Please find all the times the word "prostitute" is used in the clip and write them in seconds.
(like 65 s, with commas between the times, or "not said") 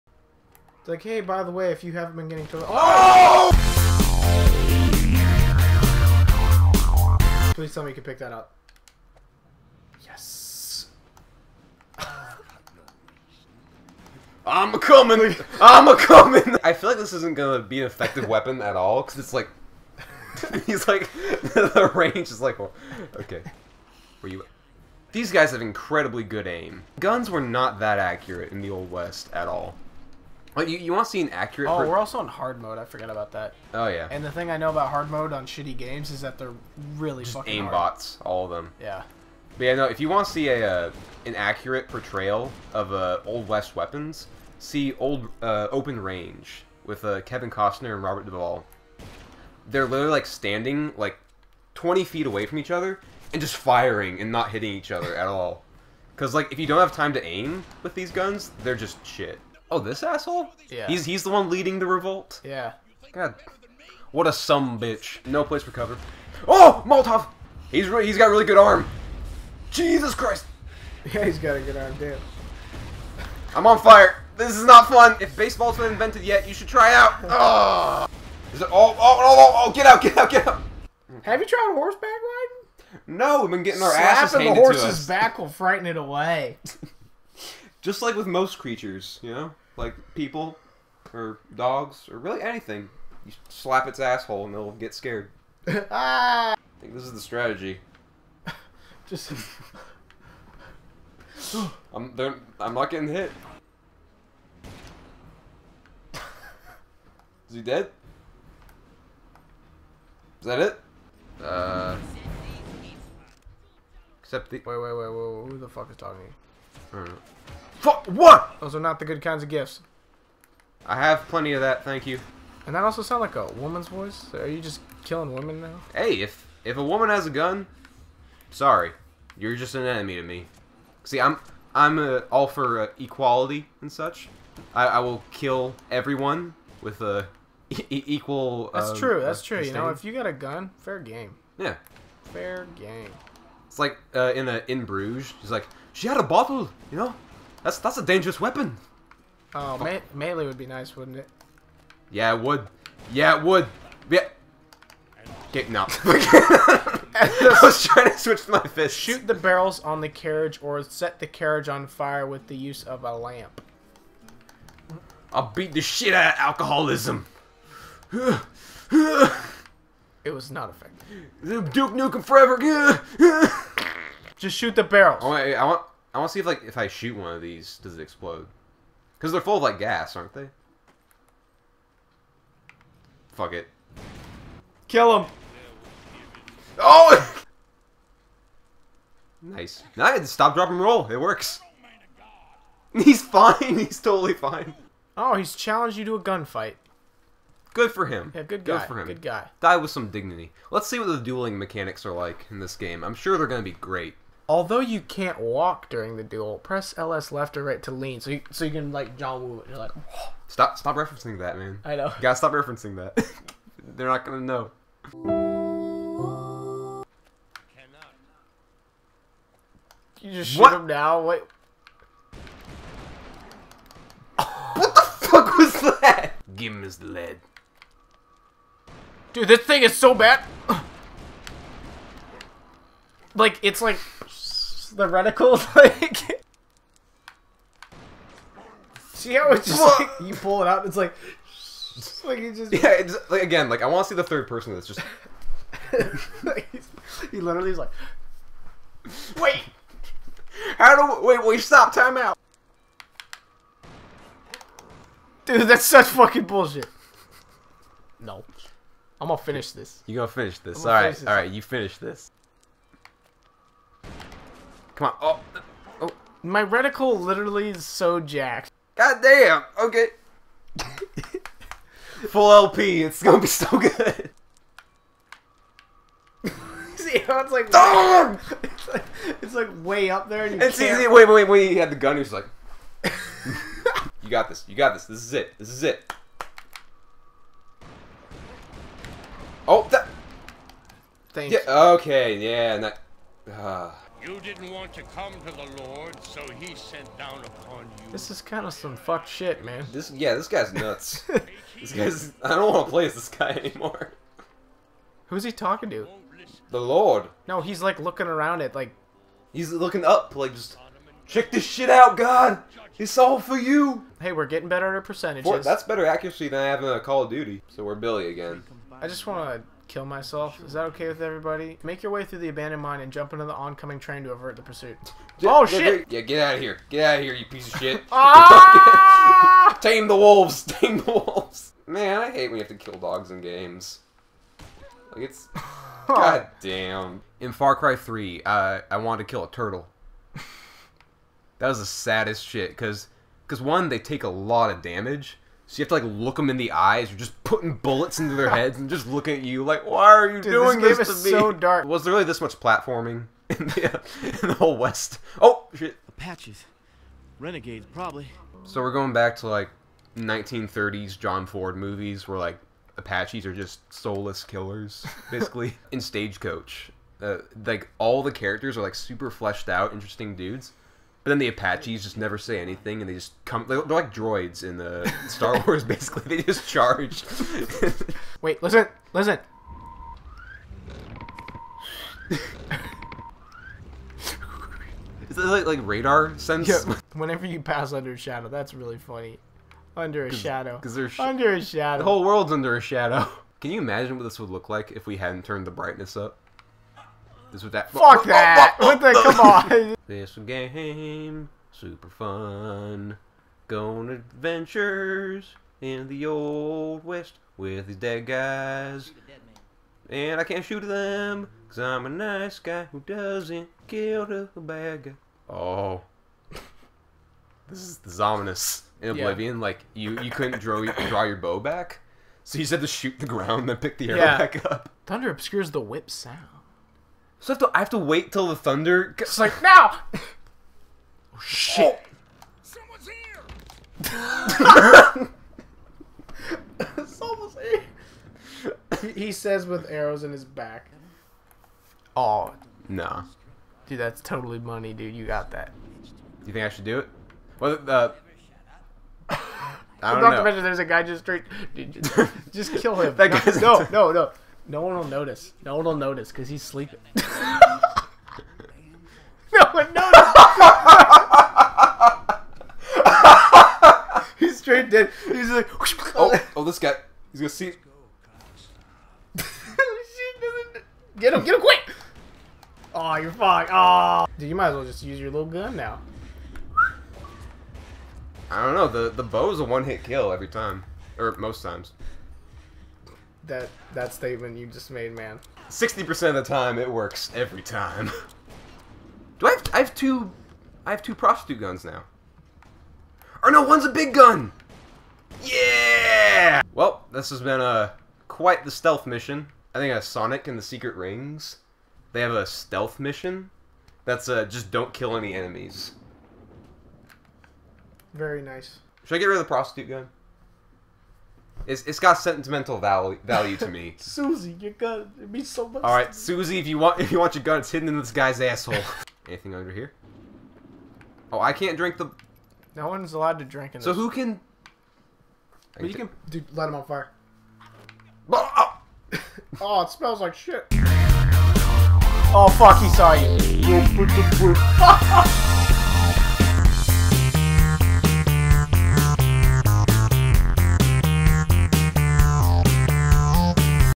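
491 s, 509 s.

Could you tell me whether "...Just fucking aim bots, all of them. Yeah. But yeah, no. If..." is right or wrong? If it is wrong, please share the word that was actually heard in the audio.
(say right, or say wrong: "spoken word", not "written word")
right.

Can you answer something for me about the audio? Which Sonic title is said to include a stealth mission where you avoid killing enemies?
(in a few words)
Sonic and the Secret Rings.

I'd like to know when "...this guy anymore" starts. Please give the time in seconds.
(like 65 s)
303 s.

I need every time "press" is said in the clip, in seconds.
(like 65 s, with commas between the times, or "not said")
206 s.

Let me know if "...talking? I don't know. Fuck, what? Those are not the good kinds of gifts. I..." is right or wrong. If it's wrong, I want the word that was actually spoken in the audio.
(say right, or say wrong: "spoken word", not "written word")
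right.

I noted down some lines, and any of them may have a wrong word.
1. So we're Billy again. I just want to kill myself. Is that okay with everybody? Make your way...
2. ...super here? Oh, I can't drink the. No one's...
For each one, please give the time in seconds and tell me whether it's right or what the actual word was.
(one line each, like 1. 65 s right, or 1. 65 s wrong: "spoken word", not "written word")
1. 317 s right
2. 519 s wrong: "under", not "super".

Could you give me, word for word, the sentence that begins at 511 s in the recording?
It's, it's got sentimental value value to me.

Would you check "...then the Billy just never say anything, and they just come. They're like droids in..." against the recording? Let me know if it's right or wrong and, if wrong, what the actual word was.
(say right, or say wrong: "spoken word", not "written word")
wrong: "Apaches", not "Billy".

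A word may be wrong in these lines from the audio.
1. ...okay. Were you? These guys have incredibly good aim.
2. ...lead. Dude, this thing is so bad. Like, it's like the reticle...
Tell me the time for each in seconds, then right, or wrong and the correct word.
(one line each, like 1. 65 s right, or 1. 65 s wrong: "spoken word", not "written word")
1. 23 s right
2. 227 s right.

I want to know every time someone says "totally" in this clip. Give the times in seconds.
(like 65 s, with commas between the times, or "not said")
194 s, 444 s.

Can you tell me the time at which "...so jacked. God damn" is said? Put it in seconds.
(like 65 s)
267 s.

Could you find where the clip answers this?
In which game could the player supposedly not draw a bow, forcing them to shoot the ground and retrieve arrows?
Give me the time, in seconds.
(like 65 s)
419 s.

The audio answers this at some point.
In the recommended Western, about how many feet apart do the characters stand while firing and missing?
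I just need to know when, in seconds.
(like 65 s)
51 s.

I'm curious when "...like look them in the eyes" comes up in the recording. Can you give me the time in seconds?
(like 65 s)
346 s.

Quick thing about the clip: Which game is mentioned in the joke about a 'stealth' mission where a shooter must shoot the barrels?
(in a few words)
Duke Nukem Forever.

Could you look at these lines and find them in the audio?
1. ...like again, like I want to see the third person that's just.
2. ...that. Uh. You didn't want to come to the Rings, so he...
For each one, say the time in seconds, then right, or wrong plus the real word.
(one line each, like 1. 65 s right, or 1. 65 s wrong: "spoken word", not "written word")
1. 243 s right
2. 292 s wrong: "Lord", not "Rings".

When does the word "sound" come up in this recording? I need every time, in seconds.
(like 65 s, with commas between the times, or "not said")
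123 s, 426 s.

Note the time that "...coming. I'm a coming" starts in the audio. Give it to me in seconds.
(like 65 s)
14 s.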